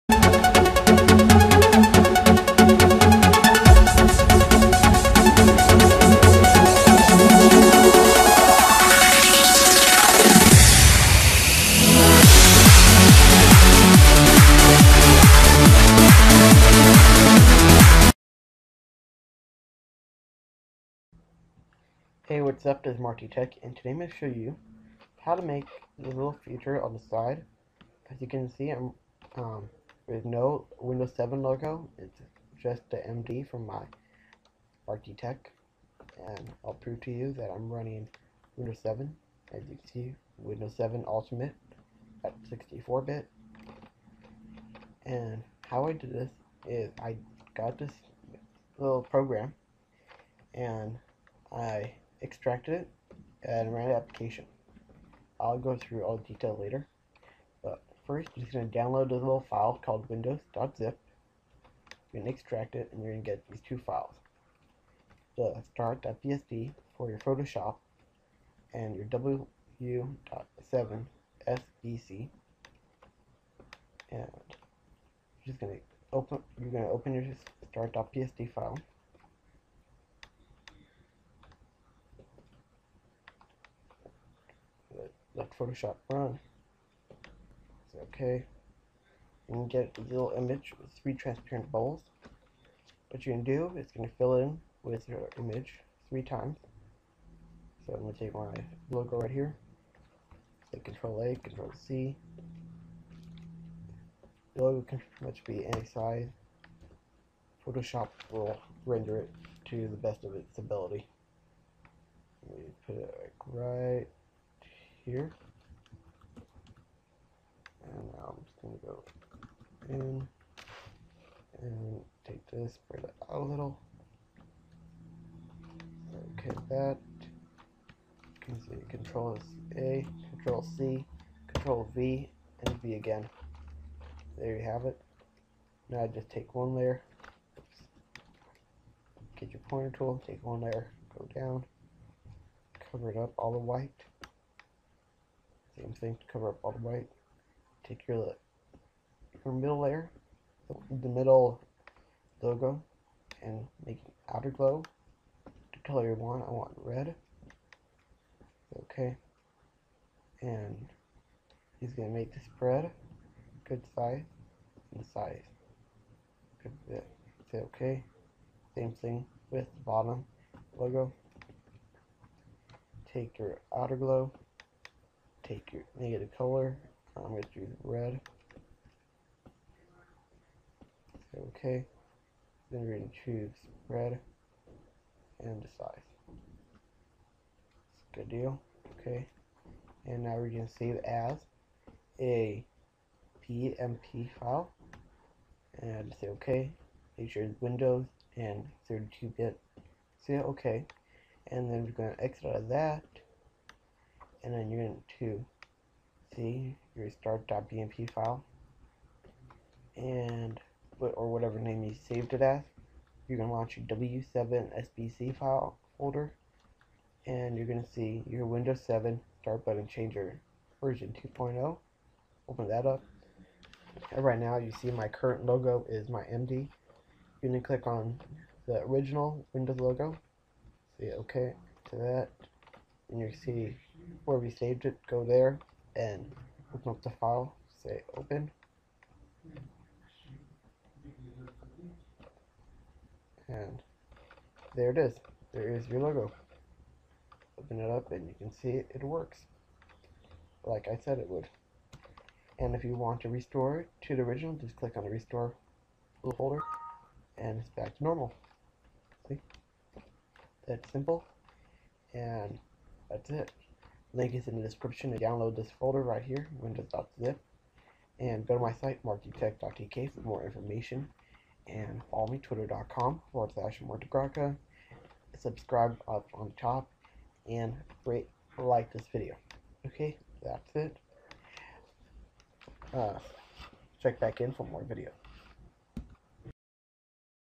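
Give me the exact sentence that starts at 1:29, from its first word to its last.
You can get a little image with three transparent bubbles.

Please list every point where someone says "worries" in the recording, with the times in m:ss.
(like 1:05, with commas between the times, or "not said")
not said.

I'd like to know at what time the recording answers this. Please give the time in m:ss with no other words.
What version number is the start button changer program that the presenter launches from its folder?
3:40.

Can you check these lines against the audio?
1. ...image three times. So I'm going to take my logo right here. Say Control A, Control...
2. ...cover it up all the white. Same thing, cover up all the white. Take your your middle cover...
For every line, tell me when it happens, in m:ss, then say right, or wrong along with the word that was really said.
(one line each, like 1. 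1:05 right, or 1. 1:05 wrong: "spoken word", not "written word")
1. 1:35 right
2. 2:22 wrong: "layer", not "cover".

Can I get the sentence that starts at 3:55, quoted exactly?
Go there and open up the file.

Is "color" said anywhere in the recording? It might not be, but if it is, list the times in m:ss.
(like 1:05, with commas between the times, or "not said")
2:35, 2:56.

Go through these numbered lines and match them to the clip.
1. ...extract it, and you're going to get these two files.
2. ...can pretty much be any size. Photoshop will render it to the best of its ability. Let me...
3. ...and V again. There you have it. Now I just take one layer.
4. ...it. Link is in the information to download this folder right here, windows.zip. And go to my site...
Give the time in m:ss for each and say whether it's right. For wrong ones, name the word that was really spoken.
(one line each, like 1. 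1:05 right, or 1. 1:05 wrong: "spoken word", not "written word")
1. 1:02 right
2. 1:44 right
3. 2:12 right
4. 4:23 wrong: "description", not "information".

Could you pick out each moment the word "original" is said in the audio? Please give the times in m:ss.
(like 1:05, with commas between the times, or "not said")
3:48, 4:14.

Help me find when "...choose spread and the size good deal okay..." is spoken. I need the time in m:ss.
3:03.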